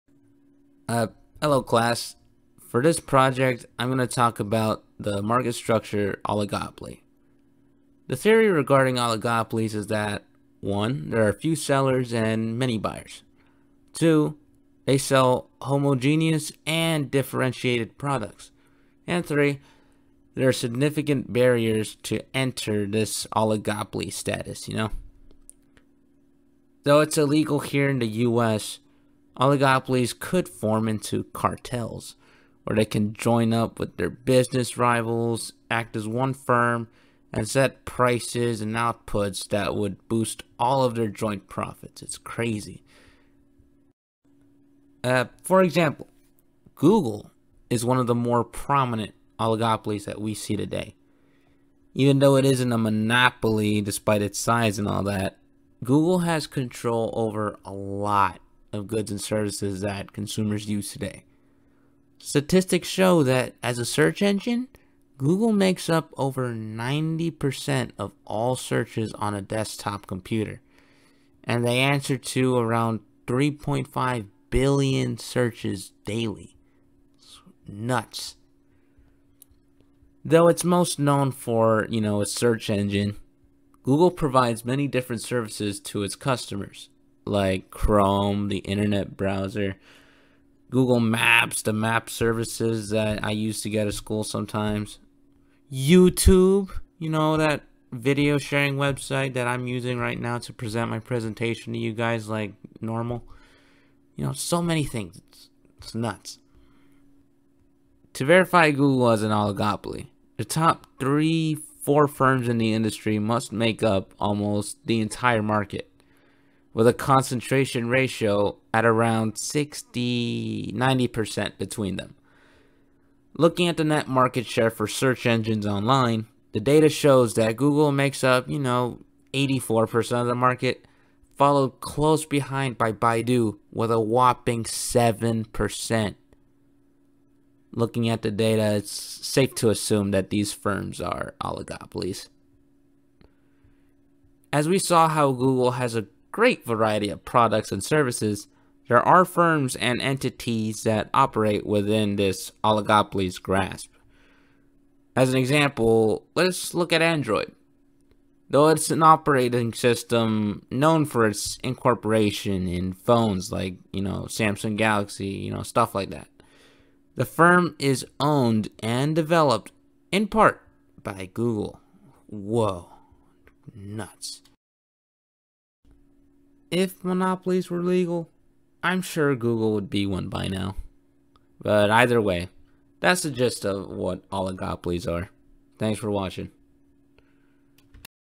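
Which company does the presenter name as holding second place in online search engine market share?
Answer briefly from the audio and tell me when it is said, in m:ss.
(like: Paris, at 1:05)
Baidu, at 2:12.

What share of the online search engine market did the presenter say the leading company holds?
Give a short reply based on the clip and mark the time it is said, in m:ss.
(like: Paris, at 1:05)
84%, at 2:09.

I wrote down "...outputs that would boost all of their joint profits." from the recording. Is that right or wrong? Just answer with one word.
right.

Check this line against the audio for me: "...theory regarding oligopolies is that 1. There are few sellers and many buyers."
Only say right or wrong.
right.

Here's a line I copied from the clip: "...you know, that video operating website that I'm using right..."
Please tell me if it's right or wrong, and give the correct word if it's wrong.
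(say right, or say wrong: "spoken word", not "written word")
wrong: "sharing", not "operating".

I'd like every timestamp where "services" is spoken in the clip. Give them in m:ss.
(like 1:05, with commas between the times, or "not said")
0:59, 1:25, 1:32, 2:27.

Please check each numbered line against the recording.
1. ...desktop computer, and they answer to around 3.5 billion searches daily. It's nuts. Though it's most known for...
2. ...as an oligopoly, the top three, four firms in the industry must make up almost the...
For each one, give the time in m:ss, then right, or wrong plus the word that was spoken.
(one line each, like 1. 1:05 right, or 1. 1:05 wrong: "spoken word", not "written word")
1. 1:09 right
2. 1:49 right.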